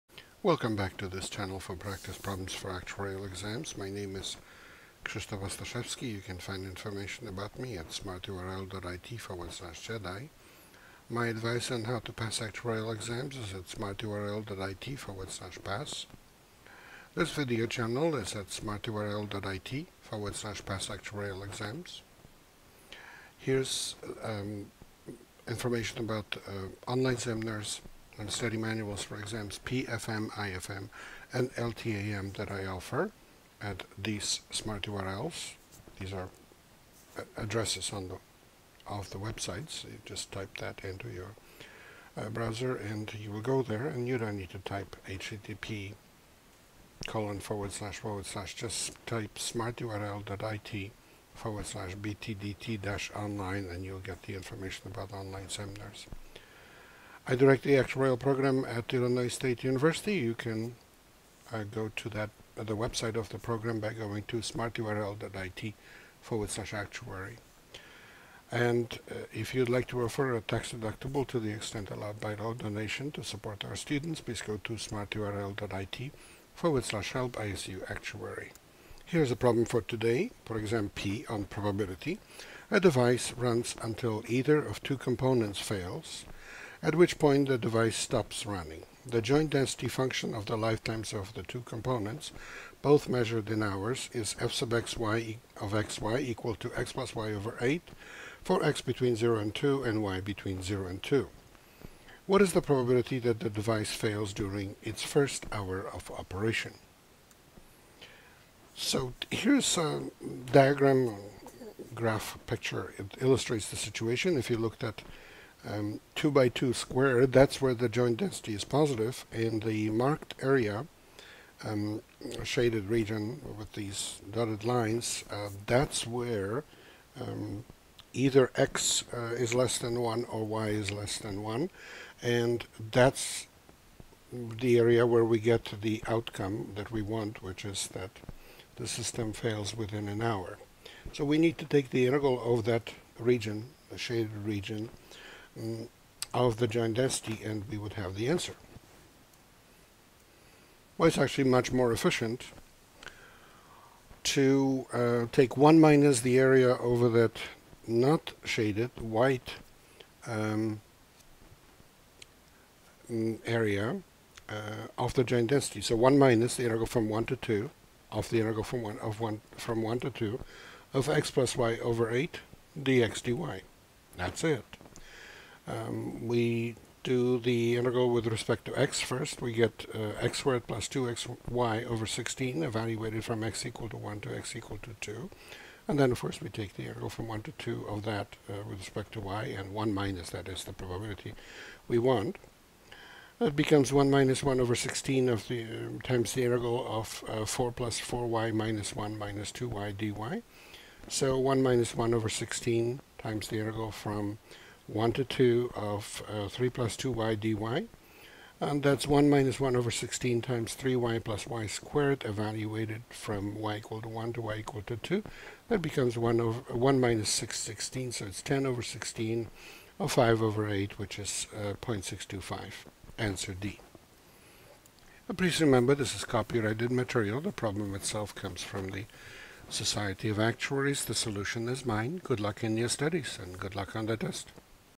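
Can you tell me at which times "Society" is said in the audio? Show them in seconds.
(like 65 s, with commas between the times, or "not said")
229 s.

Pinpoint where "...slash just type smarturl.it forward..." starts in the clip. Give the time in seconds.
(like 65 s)
48 s.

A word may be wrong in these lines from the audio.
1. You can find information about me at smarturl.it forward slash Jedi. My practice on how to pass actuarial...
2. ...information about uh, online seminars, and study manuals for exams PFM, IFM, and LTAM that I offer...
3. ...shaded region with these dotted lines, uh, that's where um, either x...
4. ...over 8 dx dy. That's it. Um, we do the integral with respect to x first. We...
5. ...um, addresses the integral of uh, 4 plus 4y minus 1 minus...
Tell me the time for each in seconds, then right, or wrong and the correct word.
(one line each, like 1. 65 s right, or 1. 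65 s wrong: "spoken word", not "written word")
1. 6 s wrong: "advice", not "practice"
2. 25 s right
3. 122 s right
4. 171 s right
5. 195 s wrong: "times", not "addresses".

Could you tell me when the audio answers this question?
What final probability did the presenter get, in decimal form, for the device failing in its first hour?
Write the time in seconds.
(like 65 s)
221 s.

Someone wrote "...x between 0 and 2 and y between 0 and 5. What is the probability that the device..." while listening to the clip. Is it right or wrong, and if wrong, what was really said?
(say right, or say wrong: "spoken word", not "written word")
wrong: "2", not "5".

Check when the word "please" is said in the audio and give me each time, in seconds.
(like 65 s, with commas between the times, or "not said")
74 s, 225 s.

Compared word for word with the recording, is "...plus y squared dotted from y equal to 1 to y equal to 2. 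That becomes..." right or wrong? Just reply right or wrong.
wrong.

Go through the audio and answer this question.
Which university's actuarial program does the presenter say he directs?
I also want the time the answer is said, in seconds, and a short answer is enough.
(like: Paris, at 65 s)
Illinois State University, at 58 s.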